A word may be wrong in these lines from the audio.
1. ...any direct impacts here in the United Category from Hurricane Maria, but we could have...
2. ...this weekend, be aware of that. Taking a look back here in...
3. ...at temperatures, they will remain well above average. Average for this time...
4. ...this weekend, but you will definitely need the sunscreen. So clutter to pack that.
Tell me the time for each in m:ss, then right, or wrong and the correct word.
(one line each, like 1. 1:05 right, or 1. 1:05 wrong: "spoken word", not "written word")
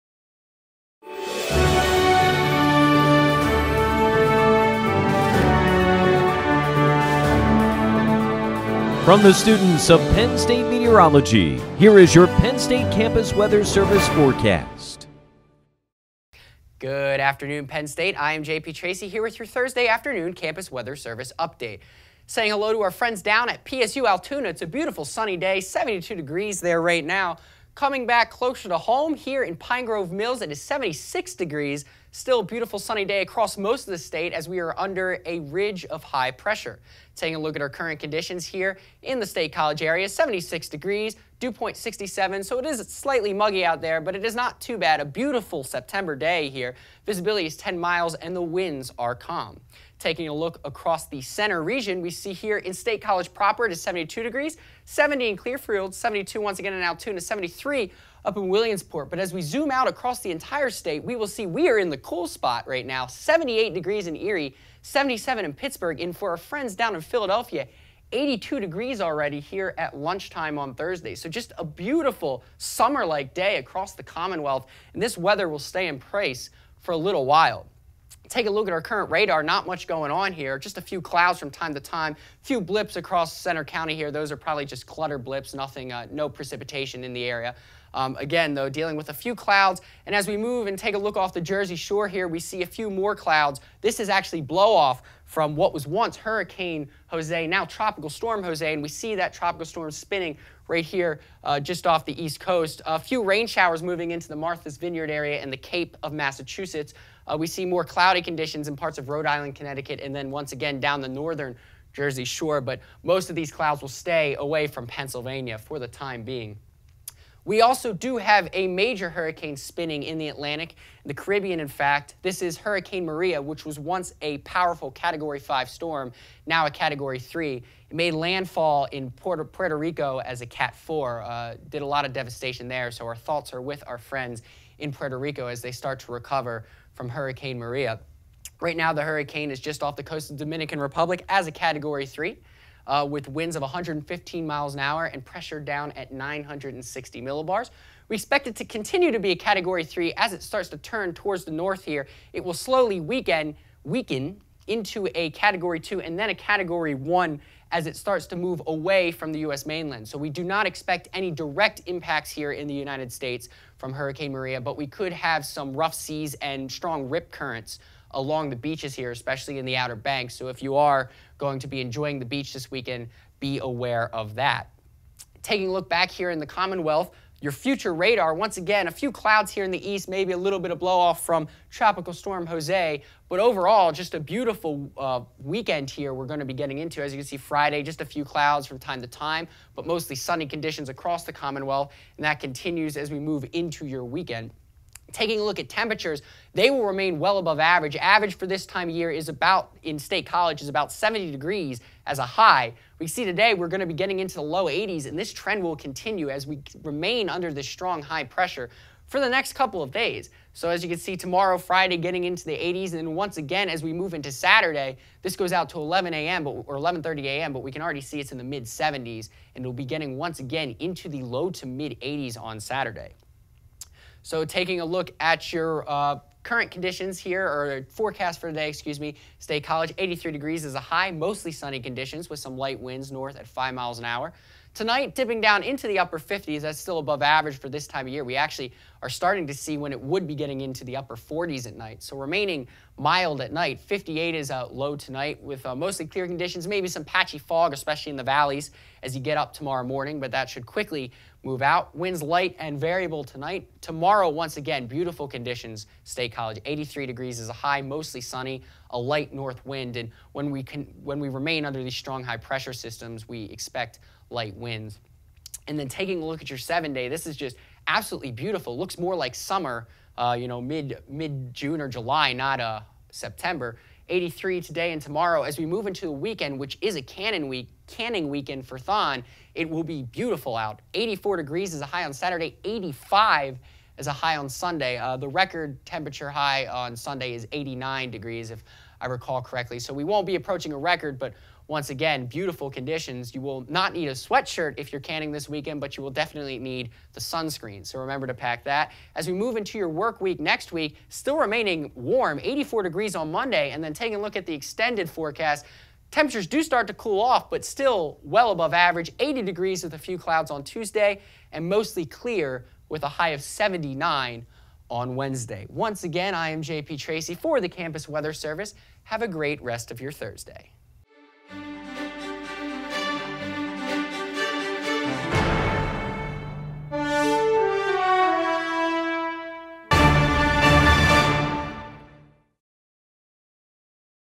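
1. 2:41 wrong: "States", not "Category"
2. 2:52 right
3. 3:15 right
4. 4:55 wrong: "remember", not "clutter".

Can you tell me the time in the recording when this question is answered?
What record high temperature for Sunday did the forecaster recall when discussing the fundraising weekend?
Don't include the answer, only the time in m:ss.
4:47.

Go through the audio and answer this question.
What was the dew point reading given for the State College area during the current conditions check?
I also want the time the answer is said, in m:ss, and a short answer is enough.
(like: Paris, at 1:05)
67, at 0:41.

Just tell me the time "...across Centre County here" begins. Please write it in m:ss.
1:22.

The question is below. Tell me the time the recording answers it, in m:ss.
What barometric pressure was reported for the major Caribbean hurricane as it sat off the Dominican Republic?
2:26.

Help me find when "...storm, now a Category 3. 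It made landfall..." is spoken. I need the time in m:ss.
2:05.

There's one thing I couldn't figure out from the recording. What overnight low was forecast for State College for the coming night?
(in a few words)
58.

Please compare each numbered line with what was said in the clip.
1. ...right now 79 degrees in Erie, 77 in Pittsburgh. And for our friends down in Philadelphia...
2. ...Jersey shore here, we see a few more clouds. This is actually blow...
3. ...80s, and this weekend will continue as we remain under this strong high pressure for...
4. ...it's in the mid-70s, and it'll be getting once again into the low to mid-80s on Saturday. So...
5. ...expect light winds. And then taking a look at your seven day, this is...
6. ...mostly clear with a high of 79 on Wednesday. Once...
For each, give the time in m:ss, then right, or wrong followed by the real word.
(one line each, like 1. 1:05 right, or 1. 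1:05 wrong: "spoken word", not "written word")
1. 1:02 wrong: "78", not "79"
2. 1:31 right
3. 3:24 wrong: "trend", not "weekend"
4. 3:38 right
5. 4:23 right
6. 5:11 right.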